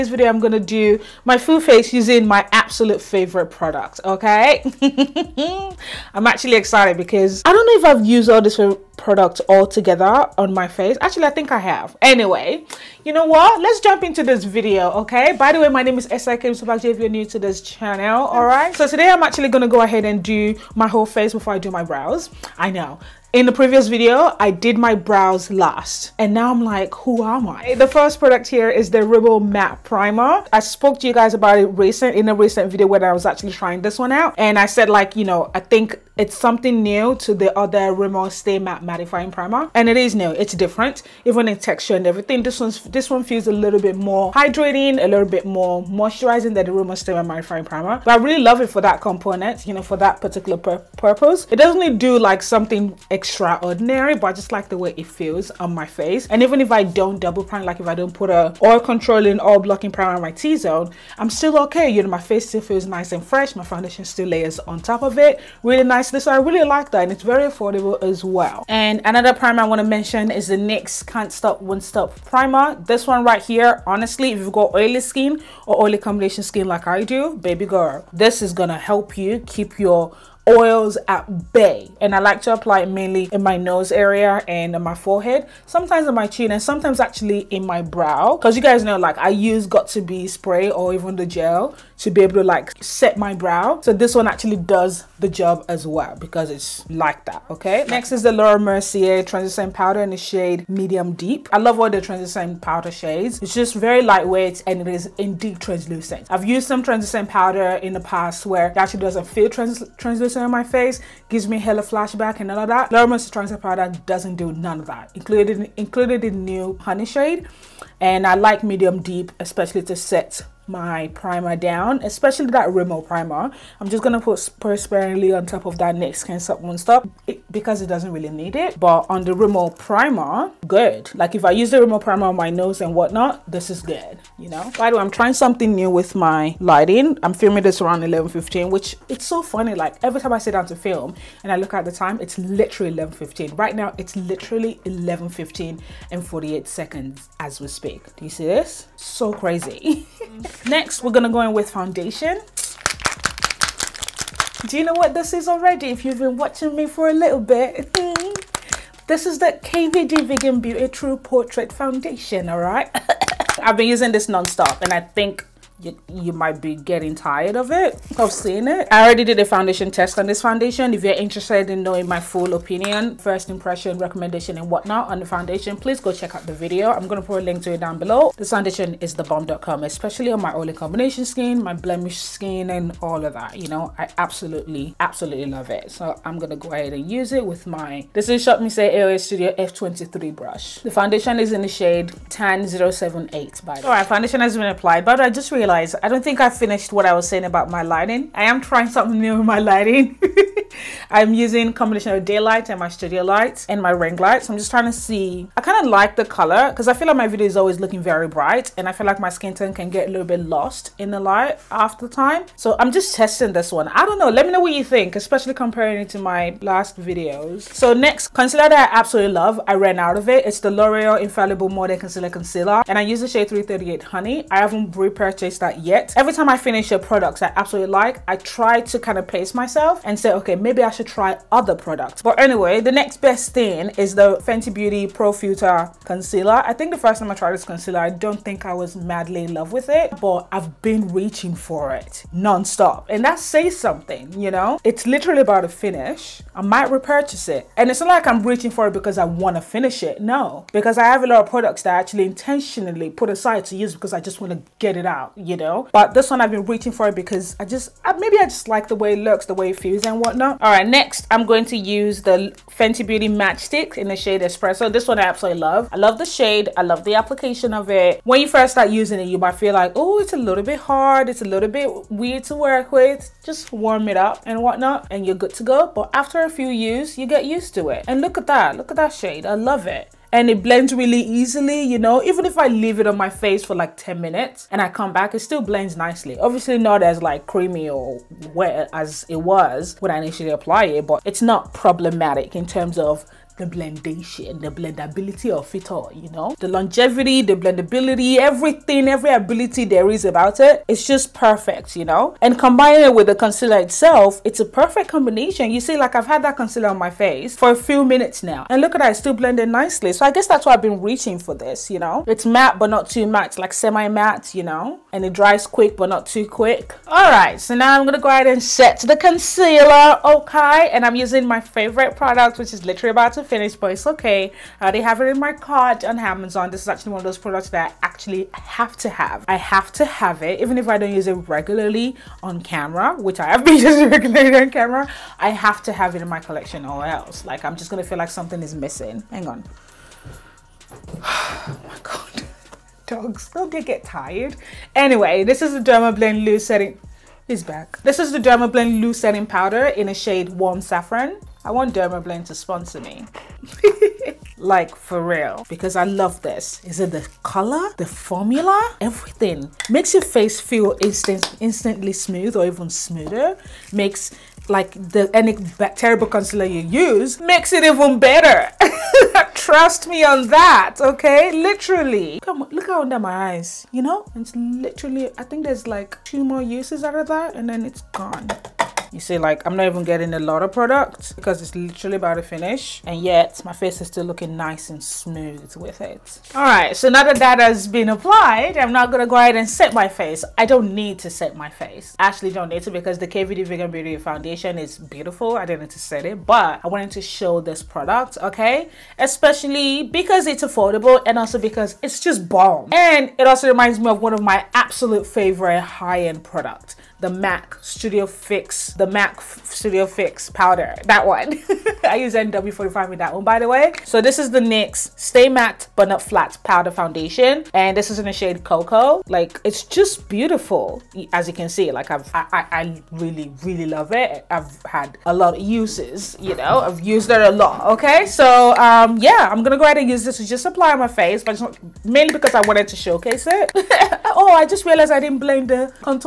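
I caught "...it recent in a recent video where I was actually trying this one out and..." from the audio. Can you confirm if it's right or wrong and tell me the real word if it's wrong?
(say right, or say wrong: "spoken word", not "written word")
right.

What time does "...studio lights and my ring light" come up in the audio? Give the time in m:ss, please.
3:22.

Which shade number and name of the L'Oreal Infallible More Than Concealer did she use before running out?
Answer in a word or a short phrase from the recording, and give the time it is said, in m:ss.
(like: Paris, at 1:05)
338 Honey, at 3:43.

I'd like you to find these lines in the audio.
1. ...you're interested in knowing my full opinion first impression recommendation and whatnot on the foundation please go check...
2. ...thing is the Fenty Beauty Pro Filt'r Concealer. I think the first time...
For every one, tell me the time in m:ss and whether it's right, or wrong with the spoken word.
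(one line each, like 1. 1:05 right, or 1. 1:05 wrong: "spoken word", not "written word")
1. 2:51 right
2. 3:53 right.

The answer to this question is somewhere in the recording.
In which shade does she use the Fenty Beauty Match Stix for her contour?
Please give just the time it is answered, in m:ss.
4:24.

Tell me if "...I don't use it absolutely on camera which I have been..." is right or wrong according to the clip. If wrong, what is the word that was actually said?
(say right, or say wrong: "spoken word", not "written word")
wrong: "regularly", not "absolutely".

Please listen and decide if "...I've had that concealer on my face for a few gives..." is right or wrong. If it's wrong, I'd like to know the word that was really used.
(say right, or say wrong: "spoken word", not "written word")
wrong: "minutes", not "gives".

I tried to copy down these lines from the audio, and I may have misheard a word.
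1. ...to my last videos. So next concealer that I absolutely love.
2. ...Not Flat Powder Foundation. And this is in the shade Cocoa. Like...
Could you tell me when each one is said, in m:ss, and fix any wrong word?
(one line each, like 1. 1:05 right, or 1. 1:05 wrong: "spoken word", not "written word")
1. 3:36 right
2. 6:56 right.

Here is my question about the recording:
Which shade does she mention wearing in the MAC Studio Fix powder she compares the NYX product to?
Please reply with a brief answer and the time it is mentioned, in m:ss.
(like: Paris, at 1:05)
NW45, at 6:52.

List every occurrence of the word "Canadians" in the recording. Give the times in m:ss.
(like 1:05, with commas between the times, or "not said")
not said.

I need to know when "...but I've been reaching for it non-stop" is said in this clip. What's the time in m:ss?
4:00.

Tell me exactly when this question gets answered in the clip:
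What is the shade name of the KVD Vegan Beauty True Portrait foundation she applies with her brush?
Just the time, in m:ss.
3:12.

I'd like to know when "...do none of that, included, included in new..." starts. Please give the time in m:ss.
1:54.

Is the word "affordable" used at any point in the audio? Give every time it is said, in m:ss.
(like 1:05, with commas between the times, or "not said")
1:07, 6:40.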